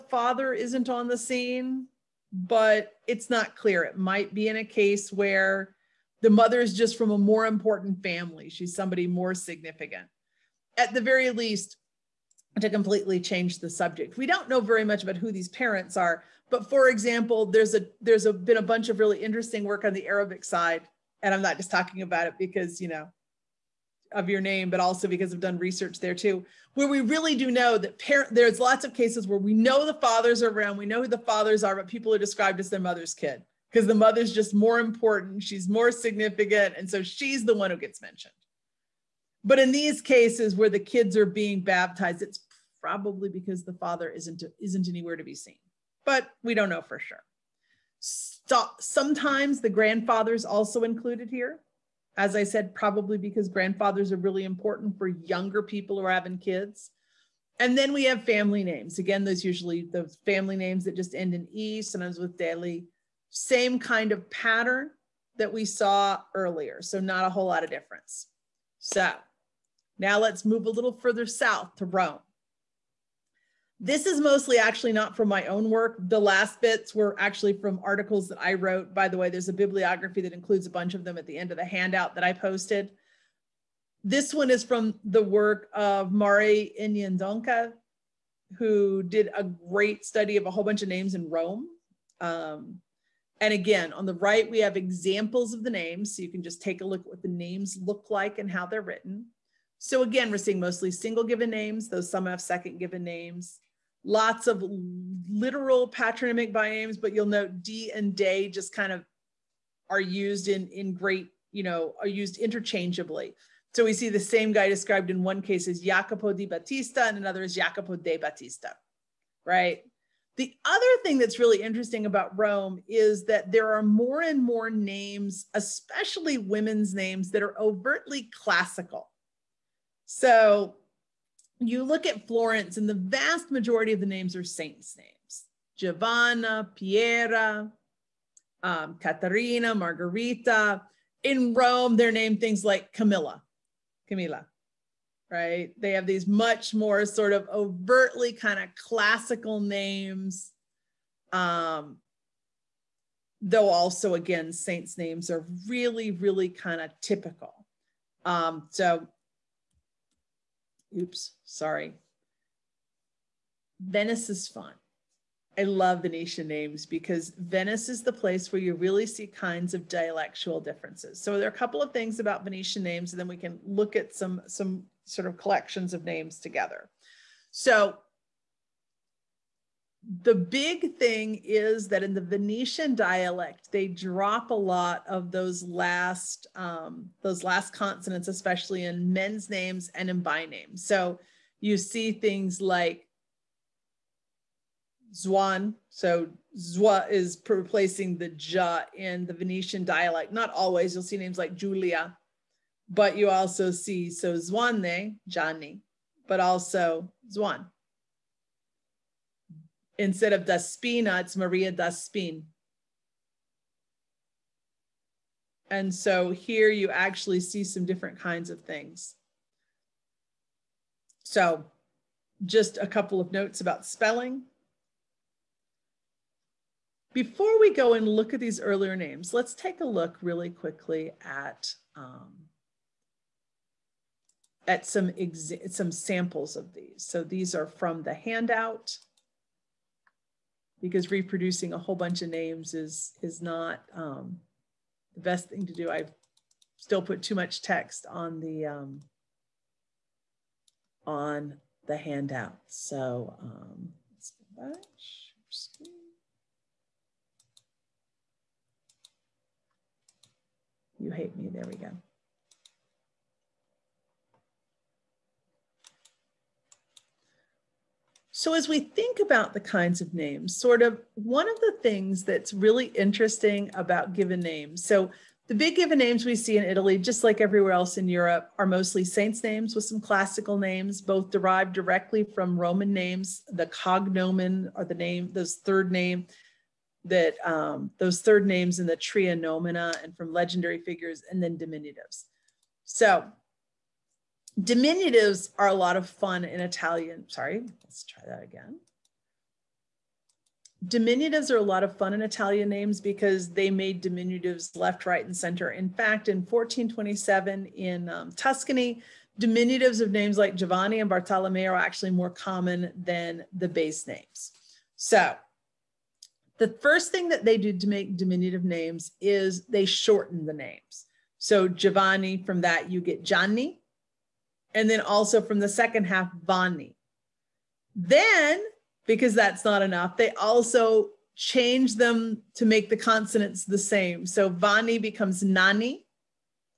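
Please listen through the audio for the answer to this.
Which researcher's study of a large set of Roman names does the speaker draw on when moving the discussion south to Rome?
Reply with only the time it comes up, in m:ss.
1:26.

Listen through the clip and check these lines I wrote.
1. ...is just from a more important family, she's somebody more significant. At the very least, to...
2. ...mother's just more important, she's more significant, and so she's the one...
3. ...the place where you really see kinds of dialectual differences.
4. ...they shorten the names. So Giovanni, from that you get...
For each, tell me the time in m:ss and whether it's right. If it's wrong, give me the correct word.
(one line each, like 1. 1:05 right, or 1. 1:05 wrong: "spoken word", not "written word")
1. 0:06 right
2. 0:33 right
3. 2:48 right
4. 5:19 right.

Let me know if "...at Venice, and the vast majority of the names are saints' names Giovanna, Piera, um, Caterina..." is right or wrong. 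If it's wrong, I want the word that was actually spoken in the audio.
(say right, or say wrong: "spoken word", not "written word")
wrong: "Florence", not "Venice".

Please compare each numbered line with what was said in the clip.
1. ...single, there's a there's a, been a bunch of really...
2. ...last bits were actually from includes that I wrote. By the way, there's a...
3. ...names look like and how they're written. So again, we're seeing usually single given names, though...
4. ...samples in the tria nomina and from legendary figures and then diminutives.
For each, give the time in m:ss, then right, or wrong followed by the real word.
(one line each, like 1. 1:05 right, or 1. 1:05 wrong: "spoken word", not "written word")
1. 0:16 wrong: "example", not "single"
2. 1:16 wrong: "articles", not "includes"
3. 1:37 wrong: "mostly", not "usually"
4. 4:48 wrong: "names", not "samples".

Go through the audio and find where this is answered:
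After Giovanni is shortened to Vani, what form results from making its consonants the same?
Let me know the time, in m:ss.
5:35.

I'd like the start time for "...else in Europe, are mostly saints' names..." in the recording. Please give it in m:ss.
4:37.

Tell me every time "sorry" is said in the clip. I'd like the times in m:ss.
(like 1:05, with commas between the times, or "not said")
2:41, 4:57.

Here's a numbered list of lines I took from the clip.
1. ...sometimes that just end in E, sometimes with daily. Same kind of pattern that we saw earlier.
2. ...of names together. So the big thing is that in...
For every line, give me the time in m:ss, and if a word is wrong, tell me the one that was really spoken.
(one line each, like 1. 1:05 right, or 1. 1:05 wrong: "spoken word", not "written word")
1. 1:00 wrong: "names", not "sometimes"
2. 2:55 right.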